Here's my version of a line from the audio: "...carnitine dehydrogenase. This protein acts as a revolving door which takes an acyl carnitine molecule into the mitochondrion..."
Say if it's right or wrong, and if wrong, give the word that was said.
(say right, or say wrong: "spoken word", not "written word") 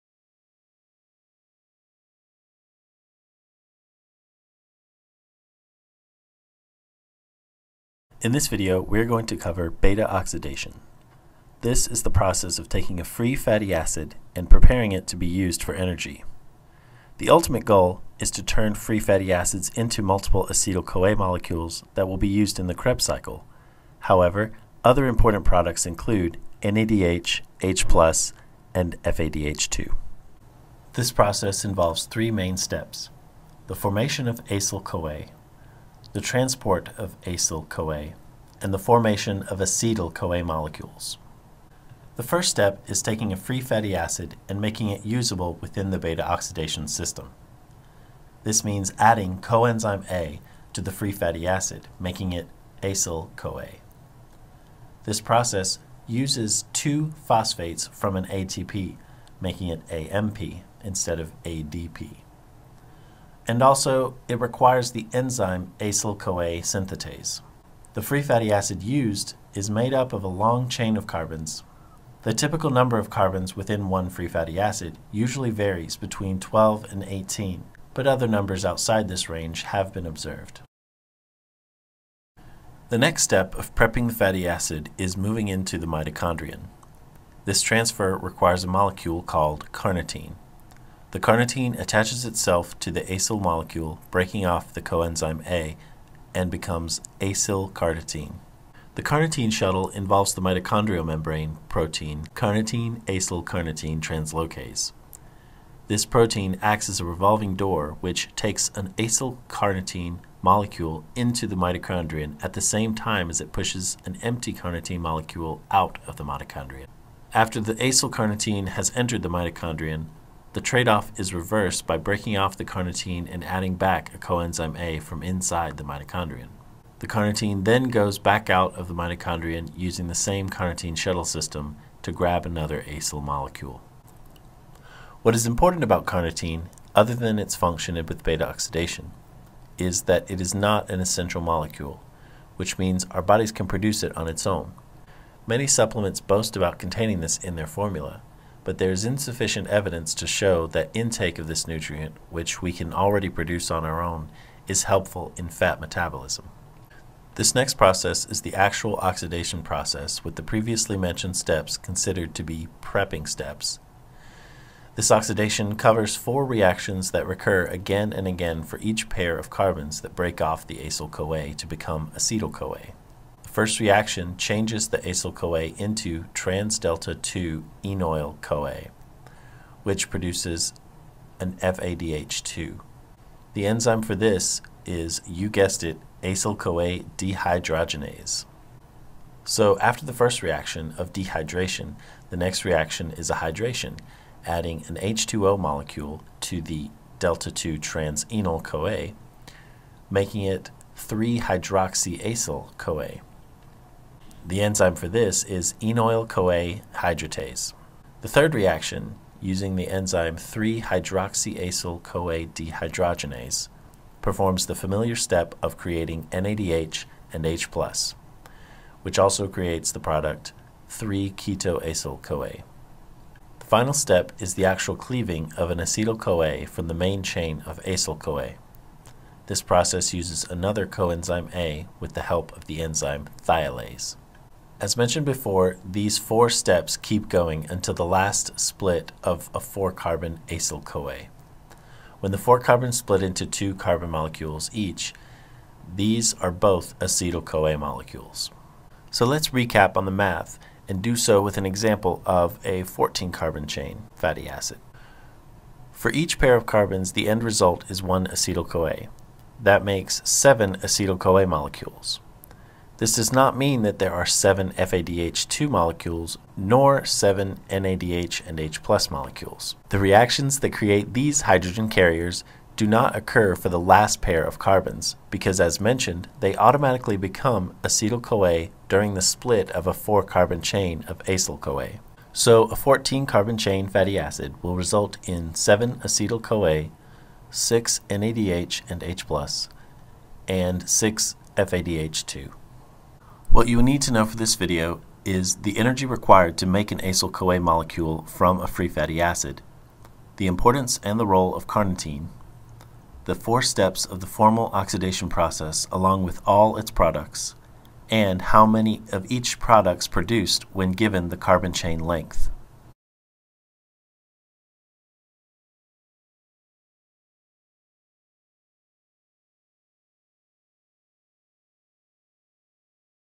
wrong: "translocase", not "dehydrogenase".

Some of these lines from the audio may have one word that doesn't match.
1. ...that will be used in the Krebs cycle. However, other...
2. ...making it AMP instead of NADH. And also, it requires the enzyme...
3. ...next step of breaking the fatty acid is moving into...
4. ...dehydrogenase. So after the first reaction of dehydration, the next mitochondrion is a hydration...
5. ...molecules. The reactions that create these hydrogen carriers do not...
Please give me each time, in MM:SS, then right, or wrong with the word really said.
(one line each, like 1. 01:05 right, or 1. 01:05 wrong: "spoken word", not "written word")
1. 00:21 right
2. 00:59 wrong: "ADP", not "NADH"
3. 01:22 wrong: "prepping", not "breaking"
4. 03:07 wrong: "reaction", not "mitochondrion"
5. 04:29 right.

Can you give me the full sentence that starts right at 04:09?
So let's recap on the math and do so with an example of a 14-carbon chain fatty acid.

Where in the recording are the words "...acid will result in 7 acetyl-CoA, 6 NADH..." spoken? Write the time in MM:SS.
04:44.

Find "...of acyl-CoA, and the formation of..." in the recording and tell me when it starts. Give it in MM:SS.
00:36.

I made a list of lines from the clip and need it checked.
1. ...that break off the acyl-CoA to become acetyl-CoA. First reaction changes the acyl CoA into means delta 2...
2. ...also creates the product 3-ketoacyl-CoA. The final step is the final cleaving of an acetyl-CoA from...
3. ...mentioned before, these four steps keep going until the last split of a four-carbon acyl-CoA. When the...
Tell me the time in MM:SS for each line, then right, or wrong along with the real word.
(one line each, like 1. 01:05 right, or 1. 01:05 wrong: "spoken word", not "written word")
1. 02:50 wrong: "trans", not "means"
2. 03:39 wrong: "actual", not "final"
3. 03:54 right.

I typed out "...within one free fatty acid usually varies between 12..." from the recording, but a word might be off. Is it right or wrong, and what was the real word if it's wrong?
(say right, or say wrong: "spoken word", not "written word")
right.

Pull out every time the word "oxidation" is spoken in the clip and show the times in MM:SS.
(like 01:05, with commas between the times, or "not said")
00:10, 00:46, 02:18, 02:38, 02:45, 05:04.